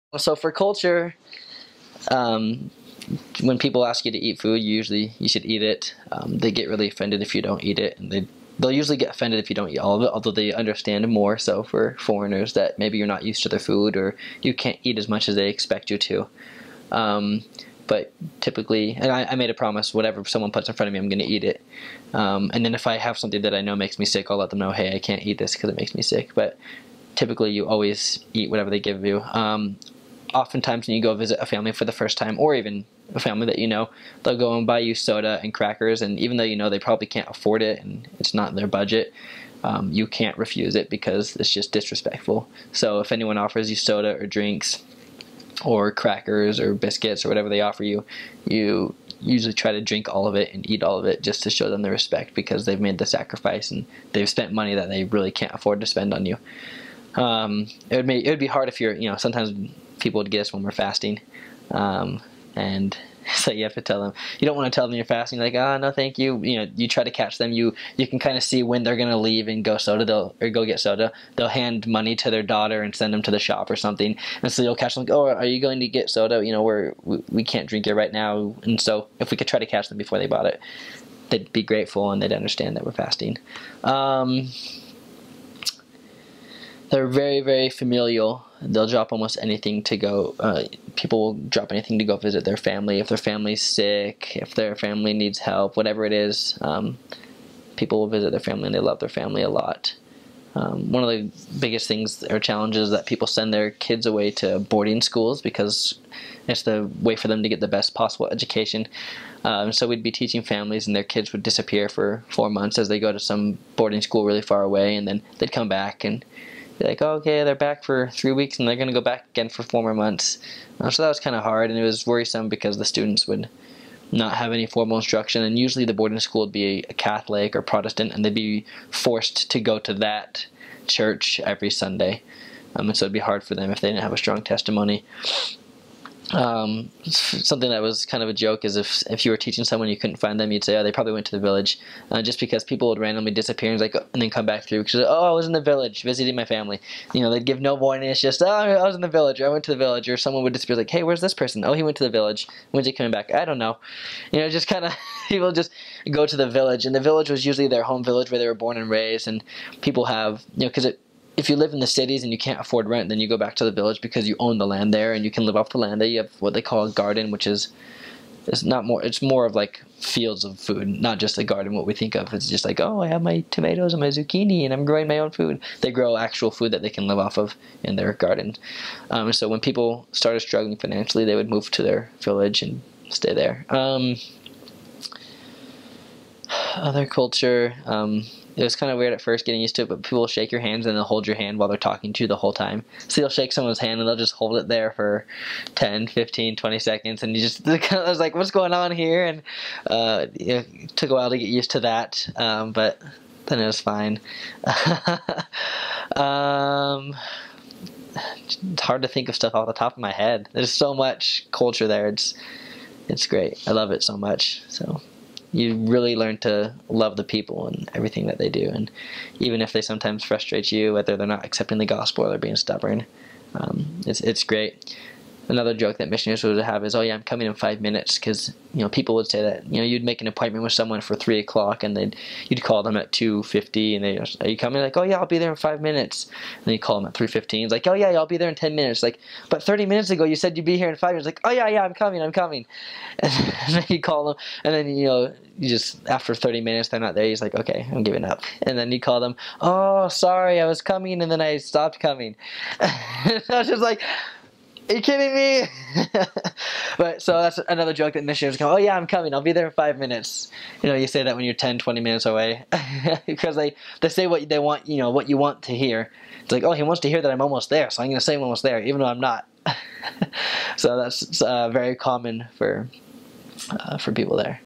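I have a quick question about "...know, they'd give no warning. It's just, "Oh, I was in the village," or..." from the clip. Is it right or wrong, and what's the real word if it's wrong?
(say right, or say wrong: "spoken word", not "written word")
right.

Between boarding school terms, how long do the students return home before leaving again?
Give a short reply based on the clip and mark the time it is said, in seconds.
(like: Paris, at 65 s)
3 weeks, at 118 s.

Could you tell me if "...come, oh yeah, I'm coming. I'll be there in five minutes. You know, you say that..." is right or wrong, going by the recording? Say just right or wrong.
right.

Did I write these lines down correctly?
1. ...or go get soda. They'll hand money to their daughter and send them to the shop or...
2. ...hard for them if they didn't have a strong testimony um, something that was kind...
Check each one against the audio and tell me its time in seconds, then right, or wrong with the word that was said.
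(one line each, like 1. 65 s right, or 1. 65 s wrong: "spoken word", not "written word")
1. 70 s right
2. 133 s right.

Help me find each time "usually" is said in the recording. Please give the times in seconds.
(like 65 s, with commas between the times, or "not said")
4 s, 8 s, 49 s, 125 s, 157 s.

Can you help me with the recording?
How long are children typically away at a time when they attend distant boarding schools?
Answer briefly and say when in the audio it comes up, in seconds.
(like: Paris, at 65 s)
4 months, at 112 s.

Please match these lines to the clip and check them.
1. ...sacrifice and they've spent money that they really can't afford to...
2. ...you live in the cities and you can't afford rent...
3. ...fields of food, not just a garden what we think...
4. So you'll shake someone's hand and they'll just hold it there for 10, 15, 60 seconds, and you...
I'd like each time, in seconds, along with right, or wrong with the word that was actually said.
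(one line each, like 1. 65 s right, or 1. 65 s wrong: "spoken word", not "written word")
1. 53 s right
2. 161 s right
3. 169 s right
4. 193 s wrong: "20", not "60".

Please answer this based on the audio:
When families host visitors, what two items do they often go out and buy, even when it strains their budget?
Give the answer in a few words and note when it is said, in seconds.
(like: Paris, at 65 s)
soda and crackers, at 34 s.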